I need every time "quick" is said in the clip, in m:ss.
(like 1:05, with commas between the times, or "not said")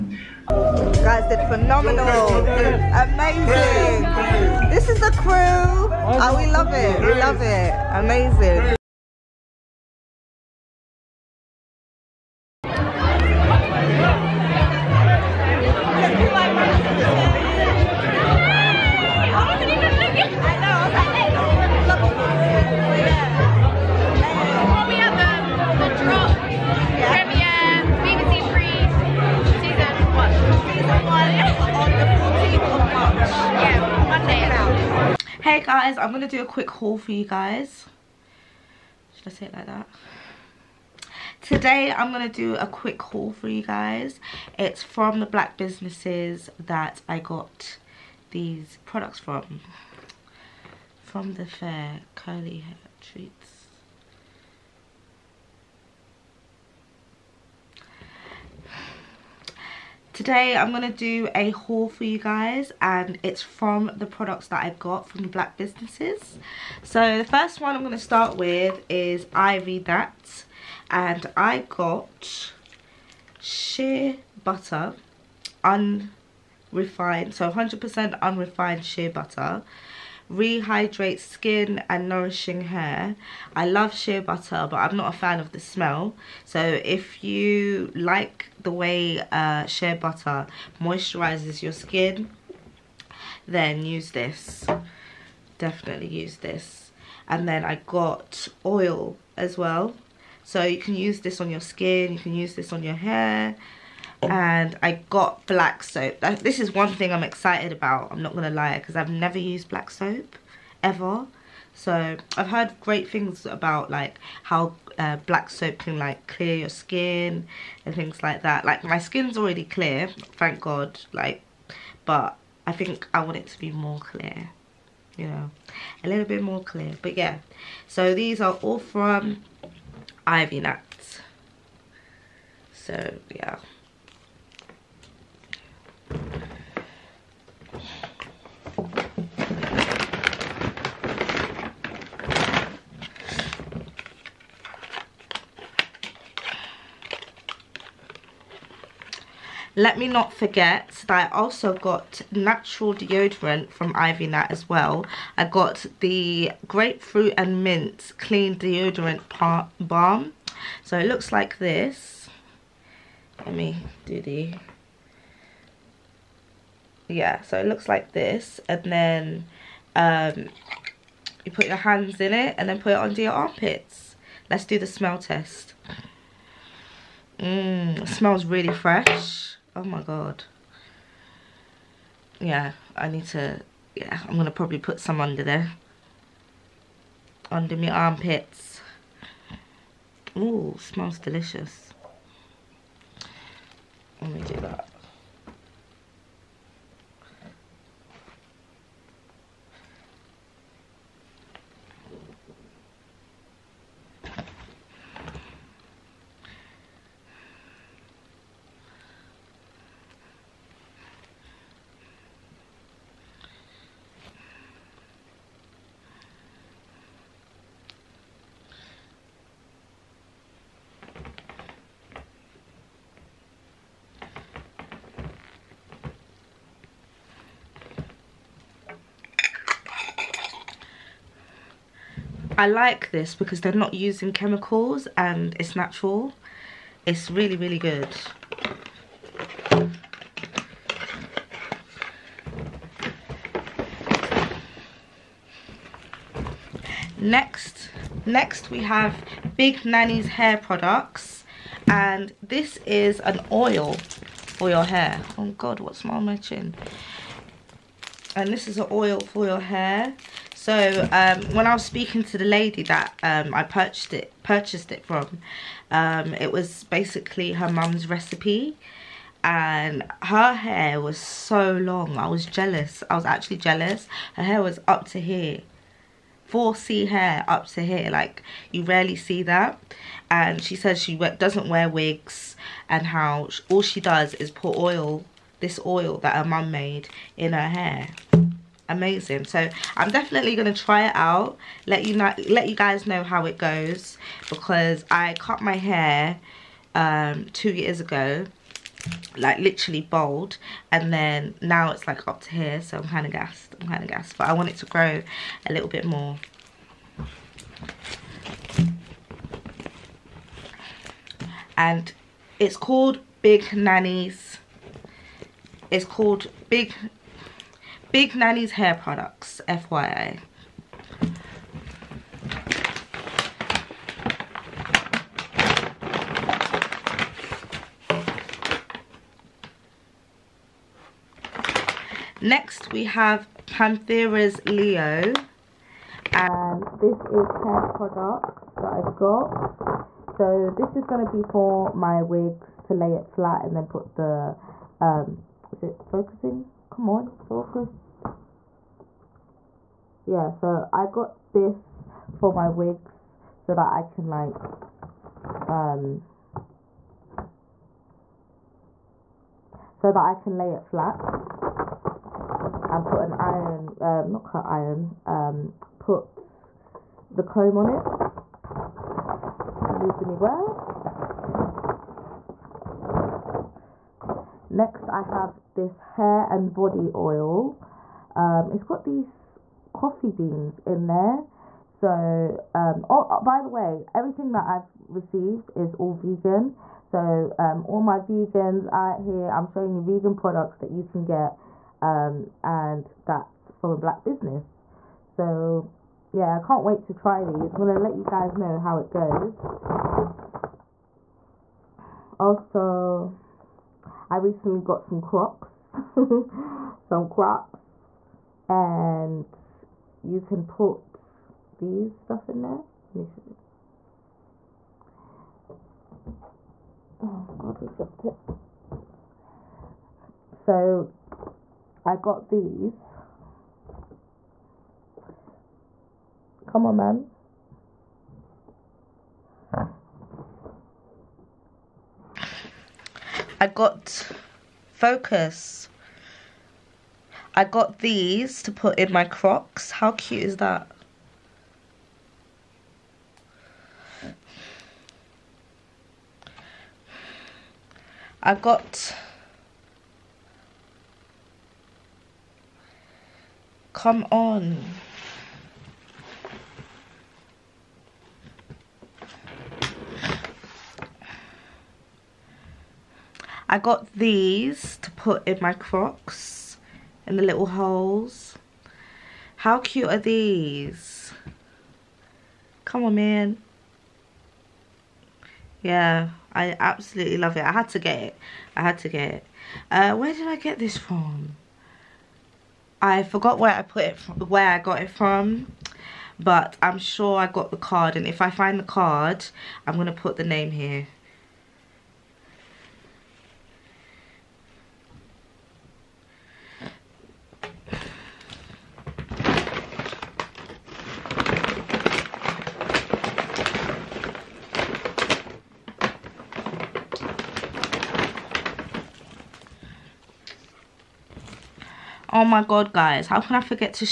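0:36, 0:42.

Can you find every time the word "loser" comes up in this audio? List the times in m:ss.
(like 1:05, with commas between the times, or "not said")
not said.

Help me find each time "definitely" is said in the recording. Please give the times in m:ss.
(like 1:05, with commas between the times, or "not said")
1:35, 4:50.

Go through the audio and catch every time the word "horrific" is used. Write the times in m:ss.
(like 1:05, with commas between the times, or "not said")
not said.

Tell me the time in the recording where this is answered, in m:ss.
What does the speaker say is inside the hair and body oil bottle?
6:19.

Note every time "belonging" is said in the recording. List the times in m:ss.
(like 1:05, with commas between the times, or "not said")
not said.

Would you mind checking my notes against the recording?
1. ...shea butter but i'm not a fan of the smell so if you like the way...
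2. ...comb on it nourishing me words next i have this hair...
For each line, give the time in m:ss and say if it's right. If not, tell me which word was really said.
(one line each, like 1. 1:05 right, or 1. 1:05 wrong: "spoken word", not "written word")
1. 1:23 right
2. 6:07 wrong: "losing", not "nourishing".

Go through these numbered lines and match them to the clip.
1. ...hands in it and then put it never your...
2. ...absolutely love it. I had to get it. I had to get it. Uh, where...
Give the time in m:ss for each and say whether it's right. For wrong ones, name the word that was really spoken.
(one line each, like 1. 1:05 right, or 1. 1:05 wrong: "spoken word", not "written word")
1. 2:51 wrong: "under", not "never"
2. 7:56 right.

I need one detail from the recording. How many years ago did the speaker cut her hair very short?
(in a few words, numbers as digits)
2.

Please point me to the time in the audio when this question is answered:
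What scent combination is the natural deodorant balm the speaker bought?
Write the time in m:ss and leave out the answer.
2:36.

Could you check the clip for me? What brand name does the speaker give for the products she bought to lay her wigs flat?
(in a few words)
Panthera's Leo.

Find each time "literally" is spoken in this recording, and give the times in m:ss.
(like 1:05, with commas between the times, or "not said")
4:59.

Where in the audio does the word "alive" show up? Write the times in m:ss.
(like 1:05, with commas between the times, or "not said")
not said.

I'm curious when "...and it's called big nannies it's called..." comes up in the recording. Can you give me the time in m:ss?
5:11.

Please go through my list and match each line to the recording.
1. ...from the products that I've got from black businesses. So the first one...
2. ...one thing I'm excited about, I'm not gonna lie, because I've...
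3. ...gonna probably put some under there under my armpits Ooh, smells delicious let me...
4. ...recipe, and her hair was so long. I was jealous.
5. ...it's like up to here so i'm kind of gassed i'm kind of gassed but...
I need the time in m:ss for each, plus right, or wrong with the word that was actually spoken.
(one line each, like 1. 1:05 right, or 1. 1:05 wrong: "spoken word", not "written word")
1. 1:03 right
2. 1:46 right
3. 3:04 right
4. 4:28 right
5. 5:01 right.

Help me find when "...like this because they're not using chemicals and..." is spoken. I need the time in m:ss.
3:52.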